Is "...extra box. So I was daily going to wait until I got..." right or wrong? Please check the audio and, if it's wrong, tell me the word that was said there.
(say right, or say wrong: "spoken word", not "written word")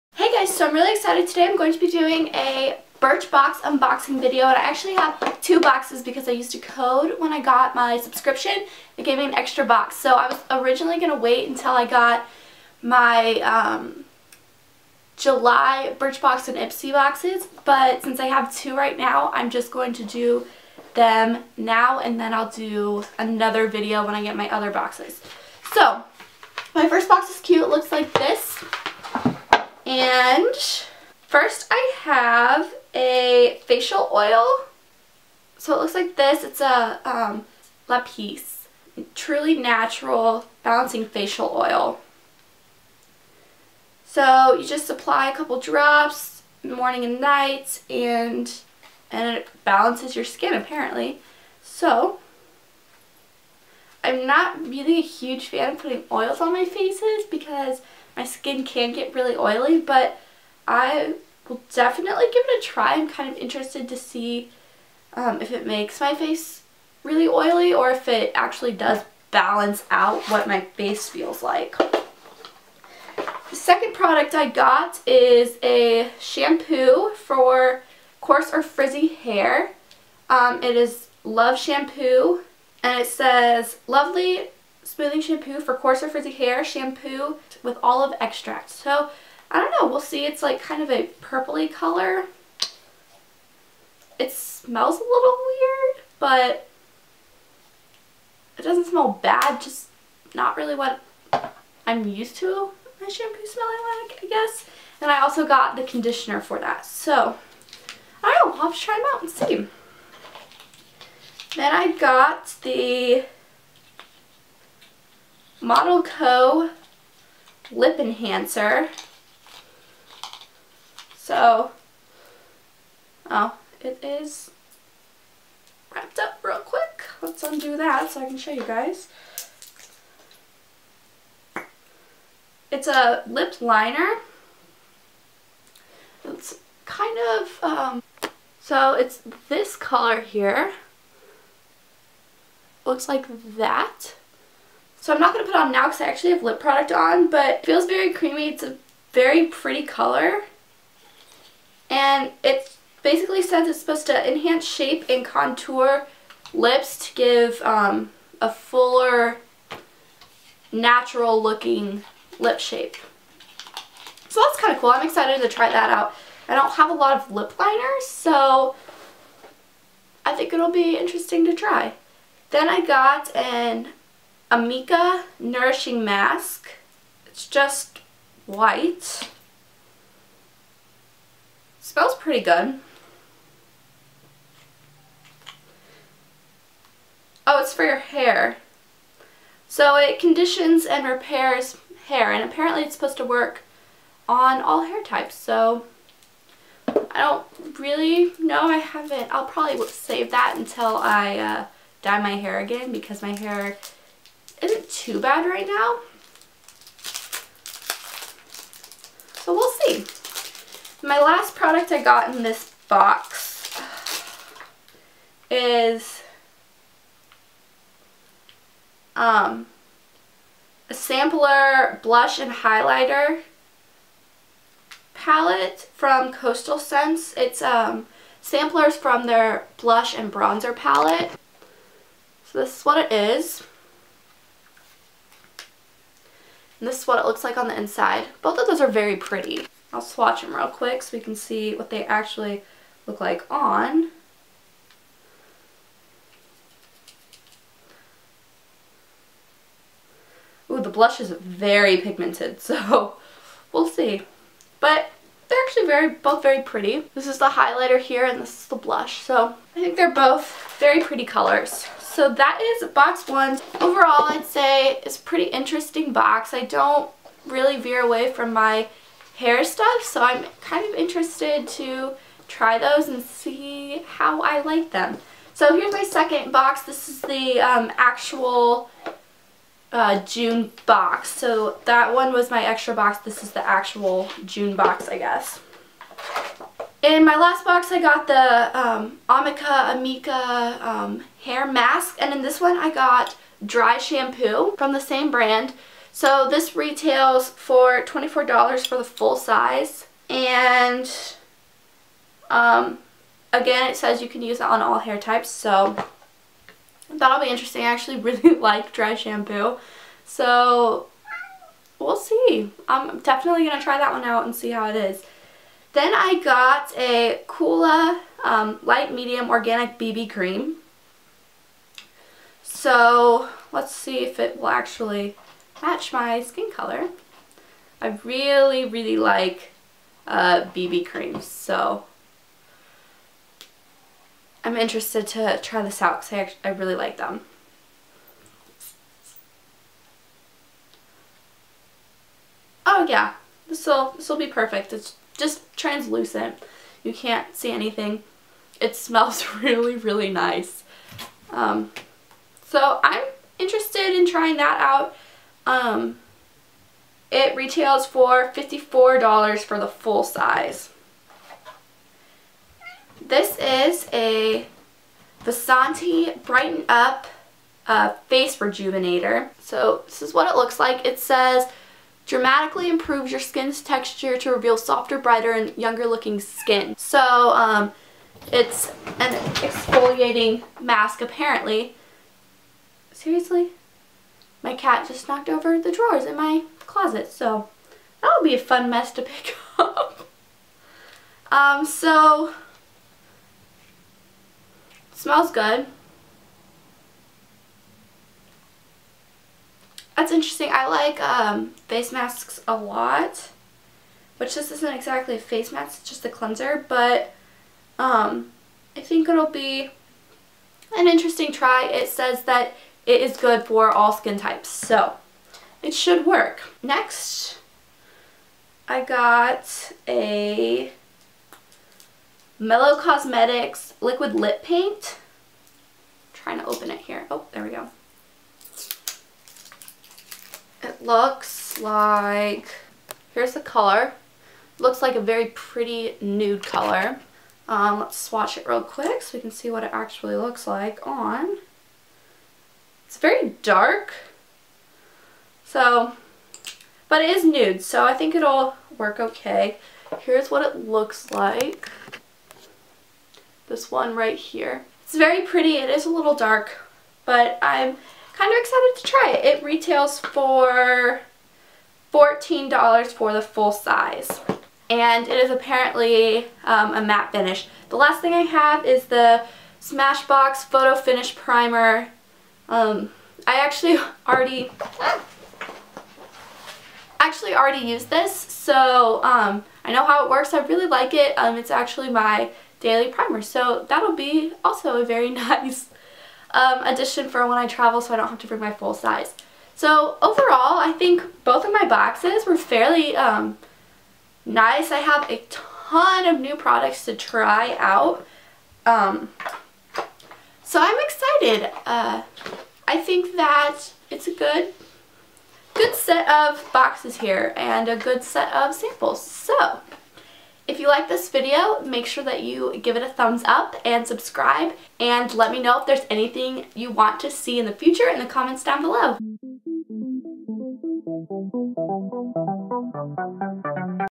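wrong: "originally", not "daily".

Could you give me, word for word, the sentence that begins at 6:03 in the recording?
This is a Vasanti Brighten Up uh, Face Rejuvenator.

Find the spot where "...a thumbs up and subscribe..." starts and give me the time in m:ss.
8:33.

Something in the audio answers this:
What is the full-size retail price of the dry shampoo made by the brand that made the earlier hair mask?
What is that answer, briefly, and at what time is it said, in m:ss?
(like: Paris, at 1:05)
$24, at 4:58.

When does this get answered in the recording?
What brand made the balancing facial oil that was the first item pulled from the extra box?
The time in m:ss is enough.
0:37.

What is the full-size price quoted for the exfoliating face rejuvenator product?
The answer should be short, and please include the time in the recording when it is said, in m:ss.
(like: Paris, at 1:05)
$54, at 5:58.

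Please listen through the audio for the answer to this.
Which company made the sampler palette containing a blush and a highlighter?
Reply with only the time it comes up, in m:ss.
3:46.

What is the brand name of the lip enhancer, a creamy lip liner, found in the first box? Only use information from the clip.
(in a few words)
Model Co.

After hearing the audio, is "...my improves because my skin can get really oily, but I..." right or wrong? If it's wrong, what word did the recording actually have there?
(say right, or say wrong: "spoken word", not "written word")
wrong: "faces", not "improves".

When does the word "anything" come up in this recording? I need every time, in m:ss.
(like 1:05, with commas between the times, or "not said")
5:47, 8:36.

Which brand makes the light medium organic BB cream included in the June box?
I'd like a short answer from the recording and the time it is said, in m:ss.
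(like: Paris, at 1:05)
Kula, at 5:17.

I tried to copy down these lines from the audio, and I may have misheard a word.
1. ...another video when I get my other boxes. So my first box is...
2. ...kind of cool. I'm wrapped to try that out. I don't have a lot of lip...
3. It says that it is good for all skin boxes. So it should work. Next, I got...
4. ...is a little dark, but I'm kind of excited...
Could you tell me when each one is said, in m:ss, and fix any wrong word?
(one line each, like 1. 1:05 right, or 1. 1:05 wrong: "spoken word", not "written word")
1. 0:23 right
2. 2:44 wrong: "excited", not "wrapped"
3. 6:51 wrong: "types", not "boxes"
4. 7:35 right.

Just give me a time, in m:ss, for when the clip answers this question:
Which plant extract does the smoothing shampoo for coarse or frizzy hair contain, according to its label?
1:27.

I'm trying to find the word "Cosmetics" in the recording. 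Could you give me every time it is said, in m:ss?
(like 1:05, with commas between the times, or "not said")
7:02.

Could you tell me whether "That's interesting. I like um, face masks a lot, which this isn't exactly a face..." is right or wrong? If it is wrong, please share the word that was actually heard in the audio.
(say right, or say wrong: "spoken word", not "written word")
right.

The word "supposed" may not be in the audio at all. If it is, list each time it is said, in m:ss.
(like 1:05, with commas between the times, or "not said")
2:33, 3:12.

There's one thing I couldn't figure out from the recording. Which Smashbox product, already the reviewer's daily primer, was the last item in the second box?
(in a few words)
Photo Finish Primer.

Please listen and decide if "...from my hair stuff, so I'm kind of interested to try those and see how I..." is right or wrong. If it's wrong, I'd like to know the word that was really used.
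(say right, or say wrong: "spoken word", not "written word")
right.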